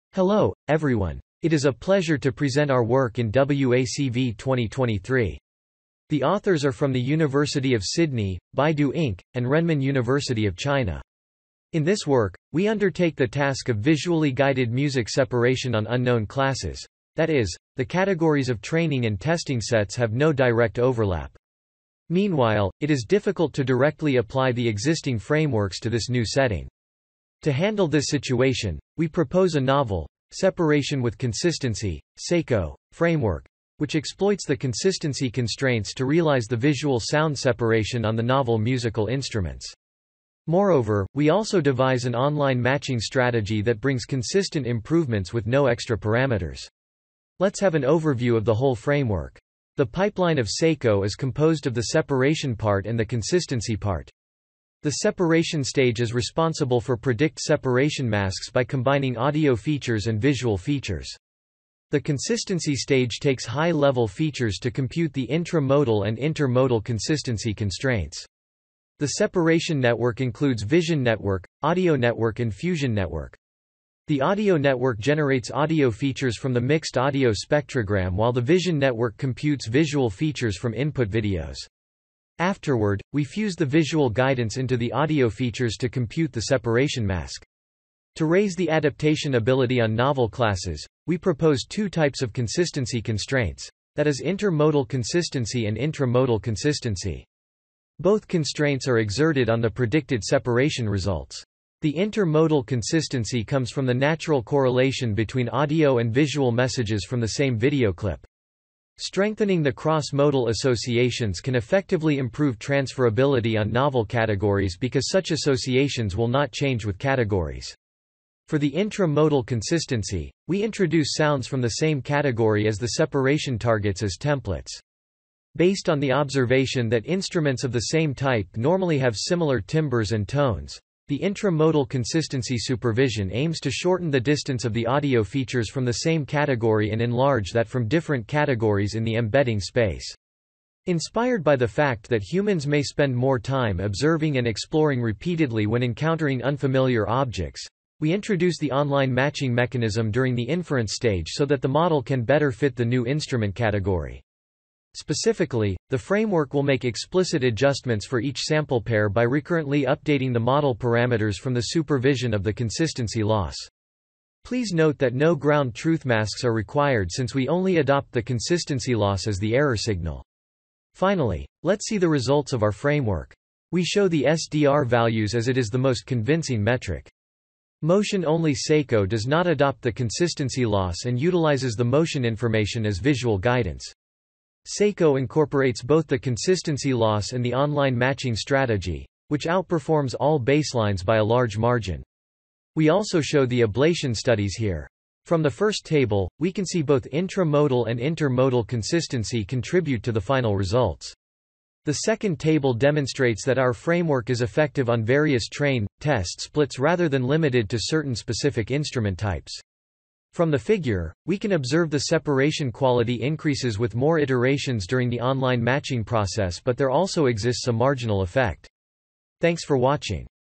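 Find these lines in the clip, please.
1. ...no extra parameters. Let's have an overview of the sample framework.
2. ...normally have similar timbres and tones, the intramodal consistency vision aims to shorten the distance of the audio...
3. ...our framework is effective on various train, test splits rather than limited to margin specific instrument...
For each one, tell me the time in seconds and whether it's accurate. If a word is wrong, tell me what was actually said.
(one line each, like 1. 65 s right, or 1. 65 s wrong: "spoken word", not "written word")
1. 45 s wrong: "whole", not "sample"
2. 128 s wrong: "supervision", not "vision"
3. 203 s wrong: "certain", not "margin".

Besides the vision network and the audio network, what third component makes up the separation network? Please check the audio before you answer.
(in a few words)
fusion network.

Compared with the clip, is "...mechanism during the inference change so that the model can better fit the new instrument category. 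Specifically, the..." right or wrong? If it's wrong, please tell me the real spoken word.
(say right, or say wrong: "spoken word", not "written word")
wrong: "stage", not "change".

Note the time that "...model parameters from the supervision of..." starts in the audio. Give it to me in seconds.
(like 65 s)
160 s.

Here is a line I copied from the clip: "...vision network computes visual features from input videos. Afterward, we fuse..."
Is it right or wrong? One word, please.
right.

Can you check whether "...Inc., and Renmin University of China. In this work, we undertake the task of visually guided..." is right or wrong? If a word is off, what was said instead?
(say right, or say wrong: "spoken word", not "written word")
right.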